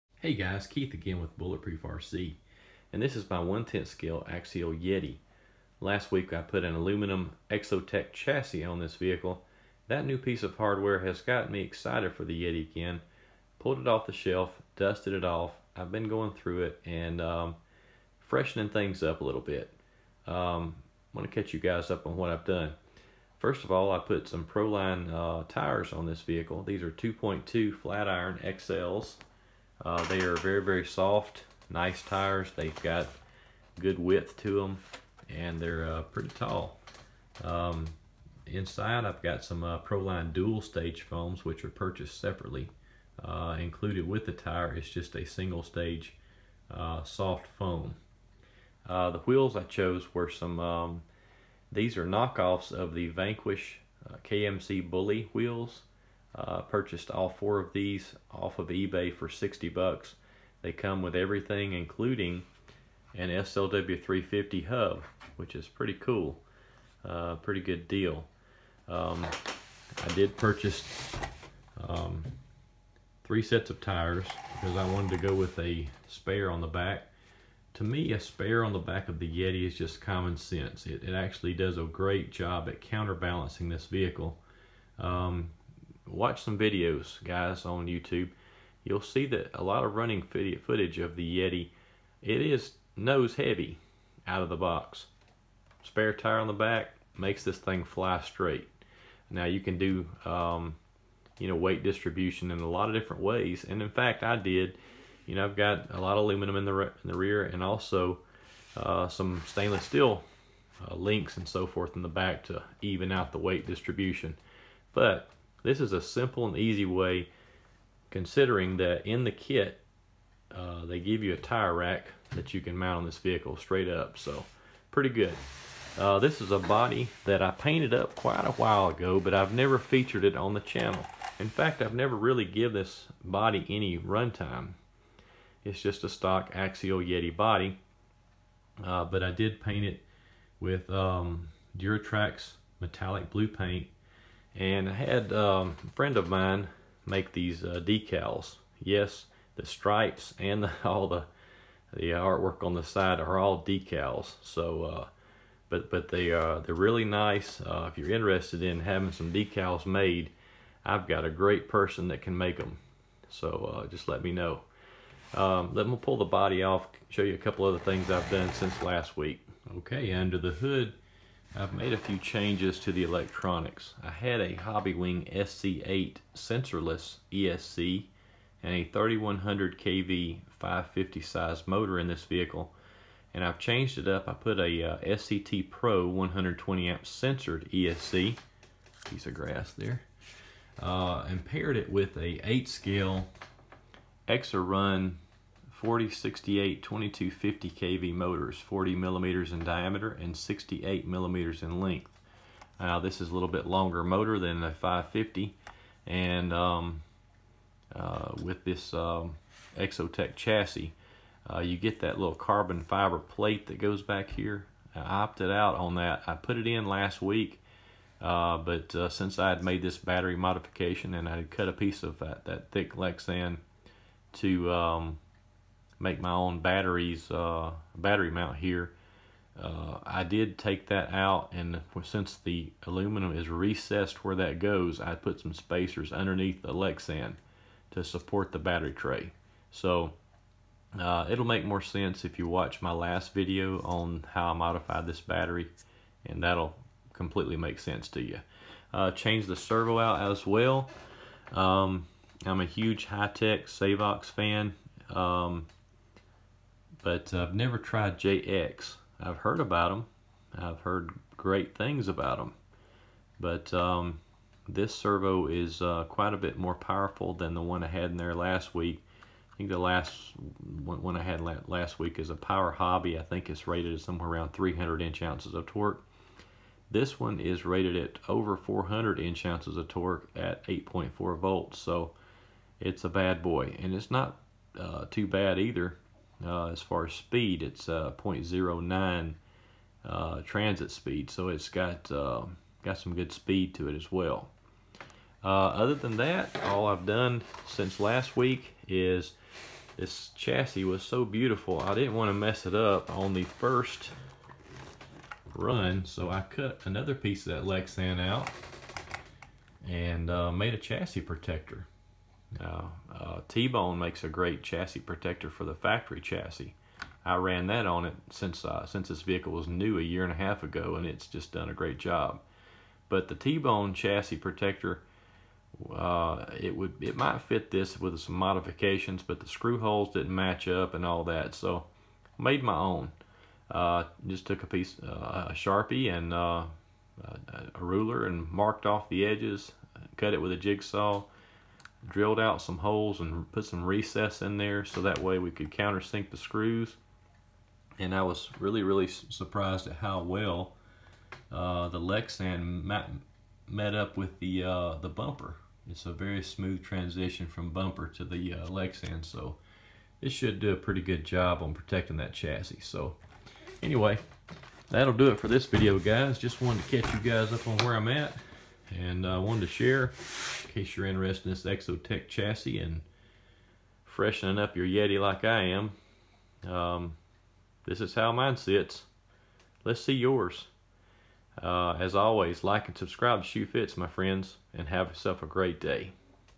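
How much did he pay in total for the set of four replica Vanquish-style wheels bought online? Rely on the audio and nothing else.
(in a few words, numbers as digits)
$60.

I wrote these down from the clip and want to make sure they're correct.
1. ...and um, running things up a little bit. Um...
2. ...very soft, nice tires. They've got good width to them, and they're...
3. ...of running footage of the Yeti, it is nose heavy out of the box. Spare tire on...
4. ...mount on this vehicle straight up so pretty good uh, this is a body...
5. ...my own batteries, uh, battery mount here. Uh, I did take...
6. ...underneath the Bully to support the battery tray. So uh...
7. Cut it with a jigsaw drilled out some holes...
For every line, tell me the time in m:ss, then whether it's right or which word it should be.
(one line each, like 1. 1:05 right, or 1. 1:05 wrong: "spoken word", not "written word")
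1. 0:16 wrong: "freshening", not "running"
2. 0:30 right
3. 1:29 right
4. 2:02 right
5. 3:46 right
6. 3:56 wrong: "Lexan", not "Bully"
7. 5:40 right.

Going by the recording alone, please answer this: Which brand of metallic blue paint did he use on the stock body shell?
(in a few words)
Duratrax.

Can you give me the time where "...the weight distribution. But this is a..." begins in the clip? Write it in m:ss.
1:53.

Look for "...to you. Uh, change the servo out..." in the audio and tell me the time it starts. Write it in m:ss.
4:08.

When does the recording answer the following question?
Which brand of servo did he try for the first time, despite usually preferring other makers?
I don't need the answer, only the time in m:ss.
4:18.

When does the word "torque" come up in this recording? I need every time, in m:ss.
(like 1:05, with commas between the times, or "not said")
4:35, 4:39.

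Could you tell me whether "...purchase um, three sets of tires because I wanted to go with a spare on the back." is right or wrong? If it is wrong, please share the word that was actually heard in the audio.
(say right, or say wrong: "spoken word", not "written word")
right.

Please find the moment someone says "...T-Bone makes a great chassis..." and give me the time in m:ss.
5:13.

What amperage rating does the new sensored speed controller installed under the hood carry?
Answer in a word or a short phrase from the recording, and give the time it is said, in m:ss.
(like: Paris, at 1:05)
120 amp, at 3:06.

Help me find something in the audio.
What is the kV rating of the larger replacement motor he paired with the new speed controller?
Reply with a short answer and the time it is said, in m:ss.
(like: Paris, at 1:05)
2250 kV, at 3:16.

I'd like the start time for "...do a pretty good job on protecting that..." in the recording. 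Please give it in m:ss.
6:00.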